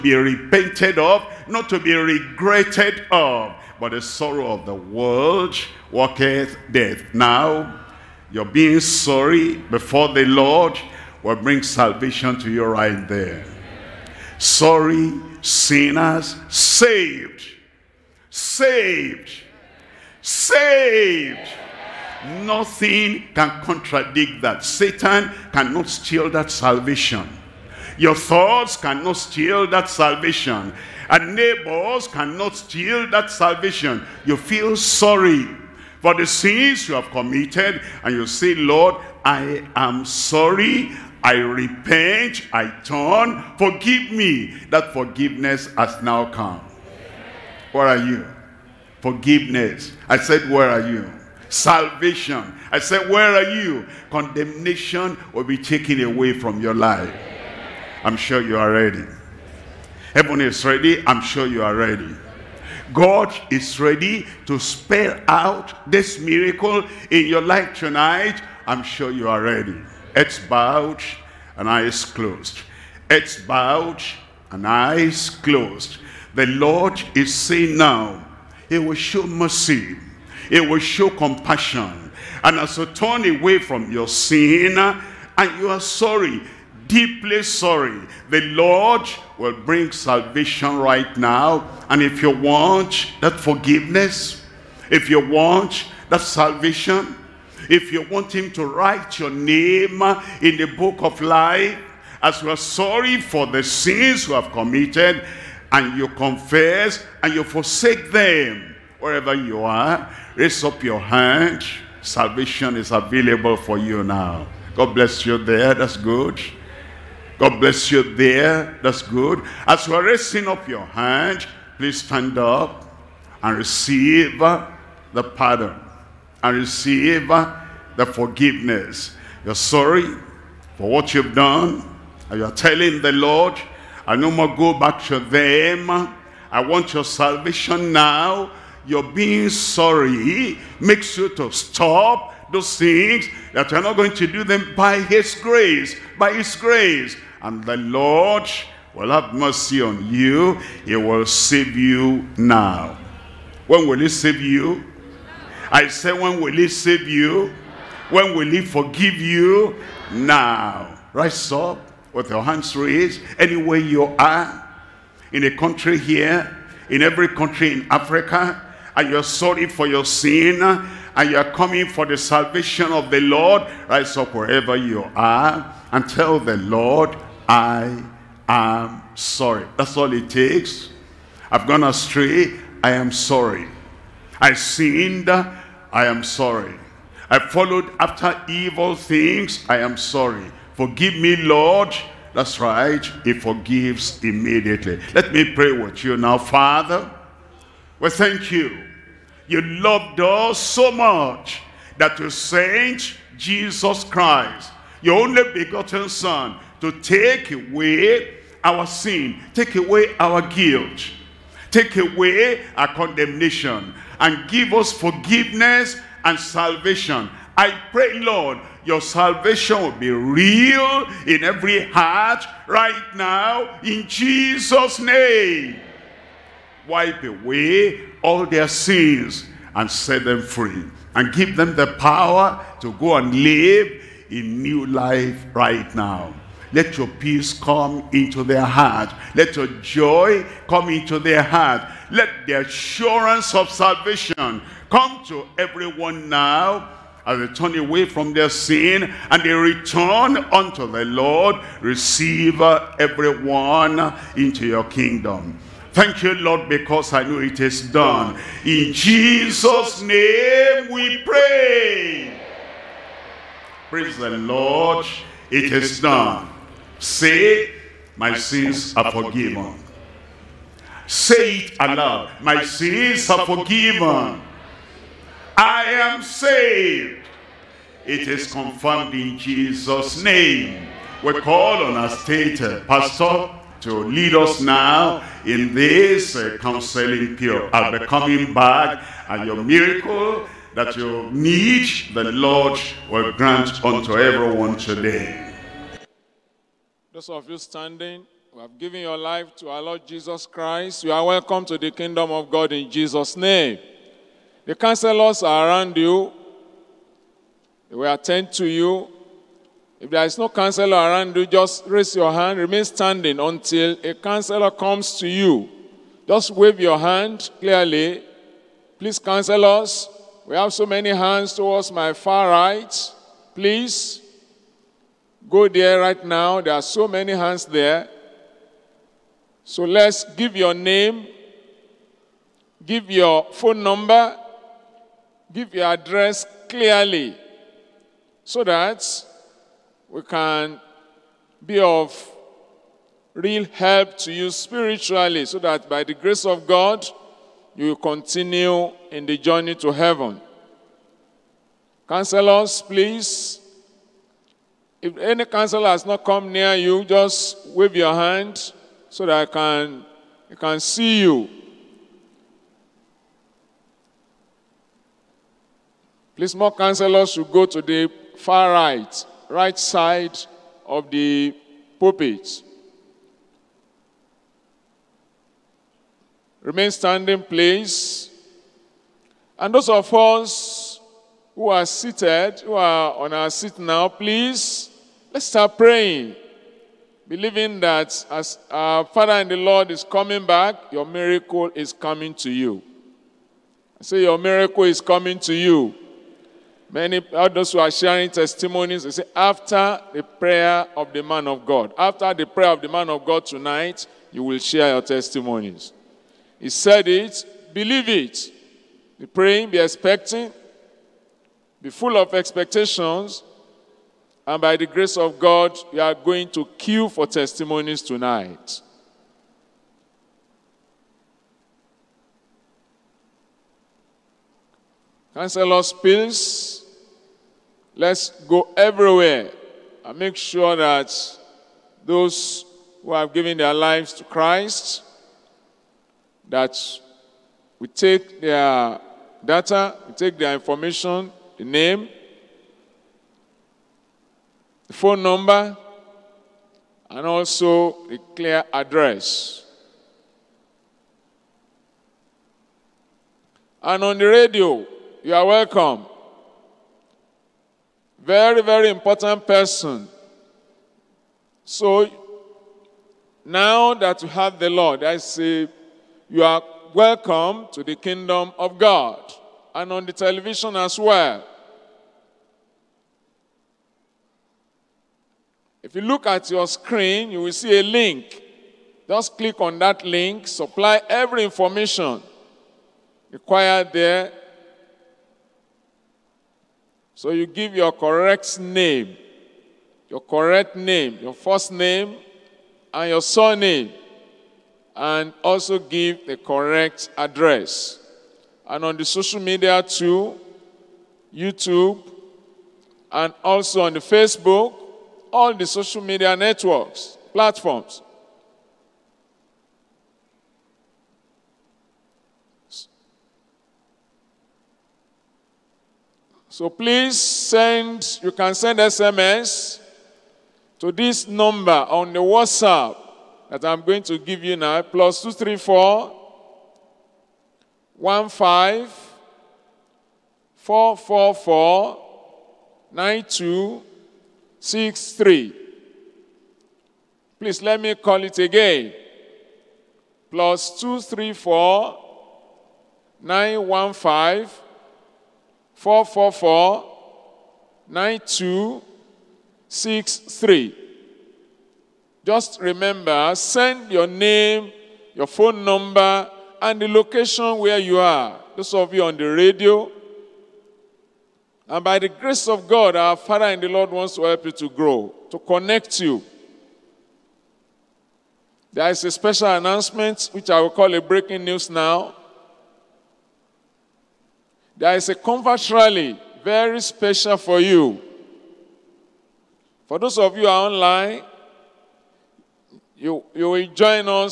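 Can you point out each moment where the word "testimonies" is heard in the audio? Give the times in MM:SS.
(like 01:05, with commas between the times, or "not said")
06:38, 06:45, 06:57.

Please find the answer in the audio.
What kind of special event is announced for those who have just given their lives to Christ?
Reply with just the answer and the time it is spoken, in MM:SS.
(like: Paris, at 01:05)
A convert rally, at 09:35.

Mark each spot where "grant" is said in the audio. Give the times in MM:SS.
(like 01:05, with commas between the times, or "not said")
04:53.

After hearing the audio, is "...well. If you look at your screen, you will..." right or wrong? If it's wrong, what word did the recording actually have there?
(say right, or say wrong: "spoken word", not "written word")
right.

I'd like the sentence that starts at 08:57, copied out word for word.
Please let me call it again.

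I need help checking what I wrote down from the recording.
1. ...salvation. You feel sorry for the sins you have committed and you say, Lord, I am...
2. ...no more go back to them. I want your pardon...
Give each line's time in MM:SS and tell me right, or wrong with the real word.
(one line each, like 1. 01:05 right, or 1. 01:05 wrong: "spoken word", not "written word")
1. 00:33 right
2. 02:14 wrong: "salvation", not "pardon".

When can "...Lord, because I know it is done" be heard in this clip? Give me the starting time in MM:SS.
04:16.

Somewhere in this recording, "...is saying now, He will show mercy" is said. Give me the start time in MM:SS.
01:17.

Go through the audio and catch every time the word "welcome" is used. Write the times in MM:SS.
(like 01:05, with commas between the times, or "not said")
05:01, 07:35, 07:46.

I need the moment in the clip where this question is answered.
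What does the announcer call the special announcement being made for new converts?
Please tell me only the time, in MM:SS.
09:31.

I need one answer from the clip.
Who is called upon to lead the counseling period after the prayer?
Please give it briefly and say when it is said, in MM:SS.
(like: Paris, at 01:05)
State pastor, at 04:42.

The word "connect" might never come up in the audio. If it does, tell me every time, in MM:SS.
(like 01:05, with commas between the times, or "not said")
09:25.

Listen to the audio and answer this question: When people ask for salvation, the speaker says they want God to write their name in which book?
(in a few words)
The book of life.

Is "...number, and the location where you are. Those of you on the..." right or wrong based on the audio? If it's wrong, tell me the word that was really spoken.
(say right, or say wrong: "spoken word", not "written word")
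right.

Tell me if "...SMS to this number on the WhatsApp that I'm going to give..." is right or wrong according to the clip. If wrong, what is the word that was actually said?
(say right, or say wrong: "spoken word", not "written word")
right.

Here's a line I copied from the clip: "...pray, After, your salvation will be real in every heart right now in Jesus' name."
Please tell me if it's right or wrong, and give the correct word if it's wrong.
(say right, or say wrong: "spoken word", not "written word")
wrong: "Lord", not "After".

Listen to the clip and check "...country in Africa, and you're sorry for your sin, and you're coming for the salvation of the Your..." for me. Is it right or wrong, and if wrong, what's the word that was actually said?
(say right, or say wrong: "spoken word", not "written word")
wrong: "Lord", not "Your".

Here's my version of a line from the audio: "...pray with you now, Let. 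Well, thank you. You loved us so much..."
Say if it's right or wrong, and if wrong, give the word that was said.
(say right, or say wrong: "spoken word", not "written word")
wrong: "Father", not "Let".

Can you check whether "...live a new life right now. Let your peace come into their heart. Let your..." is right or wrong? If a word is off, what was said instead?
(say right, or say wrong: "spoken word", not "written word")
right.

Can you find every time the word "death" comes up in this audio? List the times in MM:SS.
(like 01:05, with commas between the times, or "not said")
00:06.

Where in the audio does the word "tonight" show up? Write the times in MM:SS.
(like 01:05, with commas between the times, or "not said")
01:07, 06:43, 06:58.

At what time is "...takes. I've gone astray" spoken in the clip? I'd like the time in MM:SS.
03:00.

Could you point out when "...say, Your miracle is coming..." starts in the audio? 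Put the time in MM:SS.
06:34.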